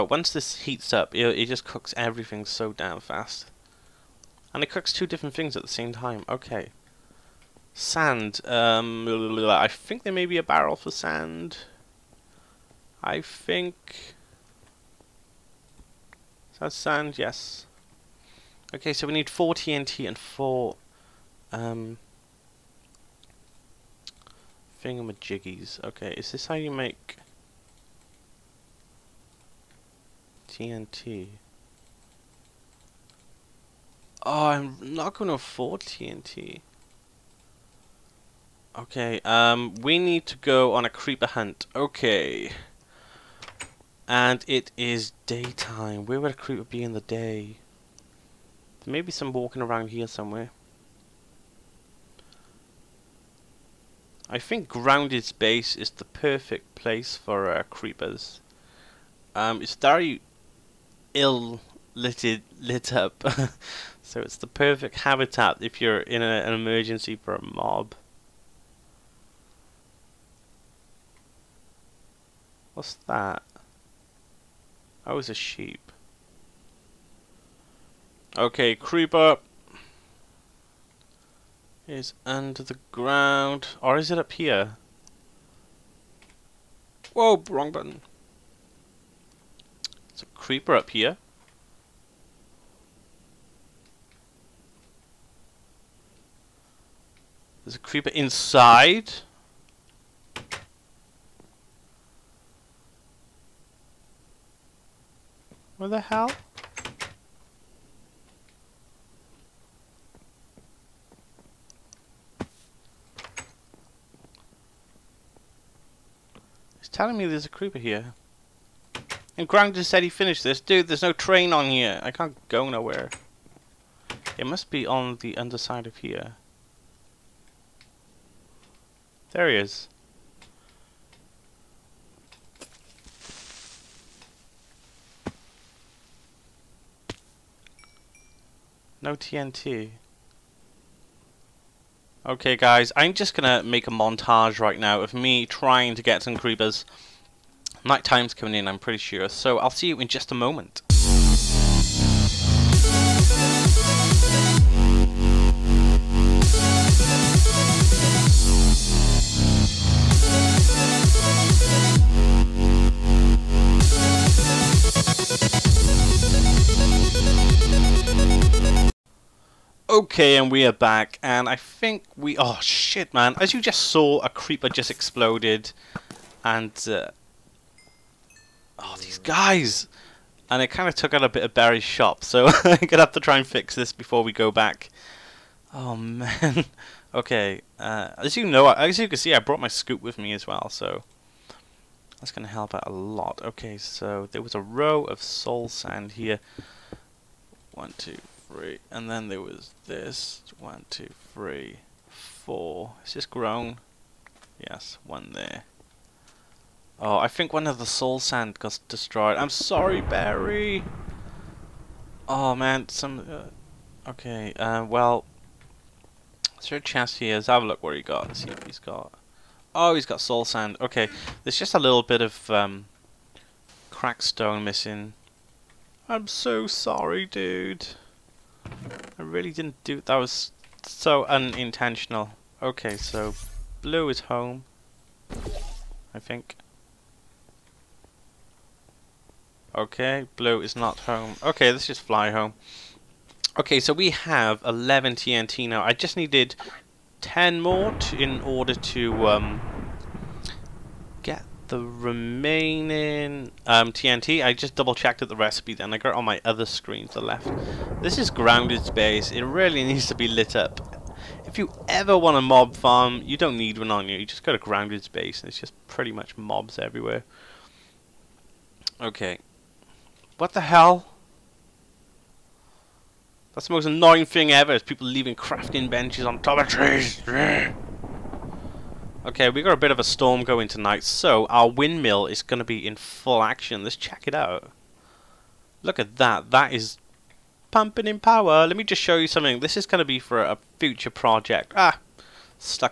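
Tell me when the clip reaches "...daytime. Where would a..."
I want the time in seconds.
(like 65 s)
45 s.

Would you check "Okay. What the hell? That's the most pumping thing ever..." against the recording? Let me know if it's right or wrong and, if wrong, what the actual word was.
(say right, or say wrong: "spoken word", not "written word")
wrong: "annoying", not "pumping".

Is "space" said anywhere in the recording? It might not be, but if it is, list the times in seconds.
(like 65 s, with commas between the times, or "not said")
55 s, 258 s, 265 s.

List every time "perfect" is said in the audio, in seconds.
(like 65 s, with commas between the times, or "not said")
56 s, 64 s.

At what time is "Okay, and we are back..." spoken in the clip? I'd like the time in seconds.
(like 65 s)
169 s.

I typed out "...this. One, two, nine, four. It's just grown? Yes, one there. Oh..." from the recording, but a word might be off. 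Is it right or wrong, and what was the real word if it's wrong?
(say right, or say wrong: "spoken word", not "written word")
wrong: "three", not "nine".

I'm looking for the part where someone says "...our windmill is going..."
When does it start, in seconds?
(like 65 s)
281 s.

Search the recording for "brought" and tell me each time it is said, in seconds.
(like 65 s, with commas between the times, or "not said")
189 s.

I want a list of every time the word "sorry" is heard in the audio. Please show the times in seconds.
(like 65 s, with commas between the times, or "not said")
209 s, 226 s.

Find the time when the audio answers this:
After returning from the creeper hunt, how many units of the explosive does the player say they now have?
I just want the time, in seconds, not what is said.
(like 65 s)
244 s.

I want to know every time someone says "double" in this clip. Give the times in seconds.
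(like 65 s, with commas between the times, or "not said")
254 s.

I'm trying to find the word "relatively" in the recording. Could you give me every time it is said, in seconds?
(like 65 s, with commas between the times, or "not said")
not said.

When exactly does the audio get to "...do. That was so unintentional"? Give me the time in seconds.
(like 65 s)
229 s.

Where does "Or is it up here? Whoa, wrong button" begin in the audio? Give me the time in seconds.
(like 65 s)
83 s.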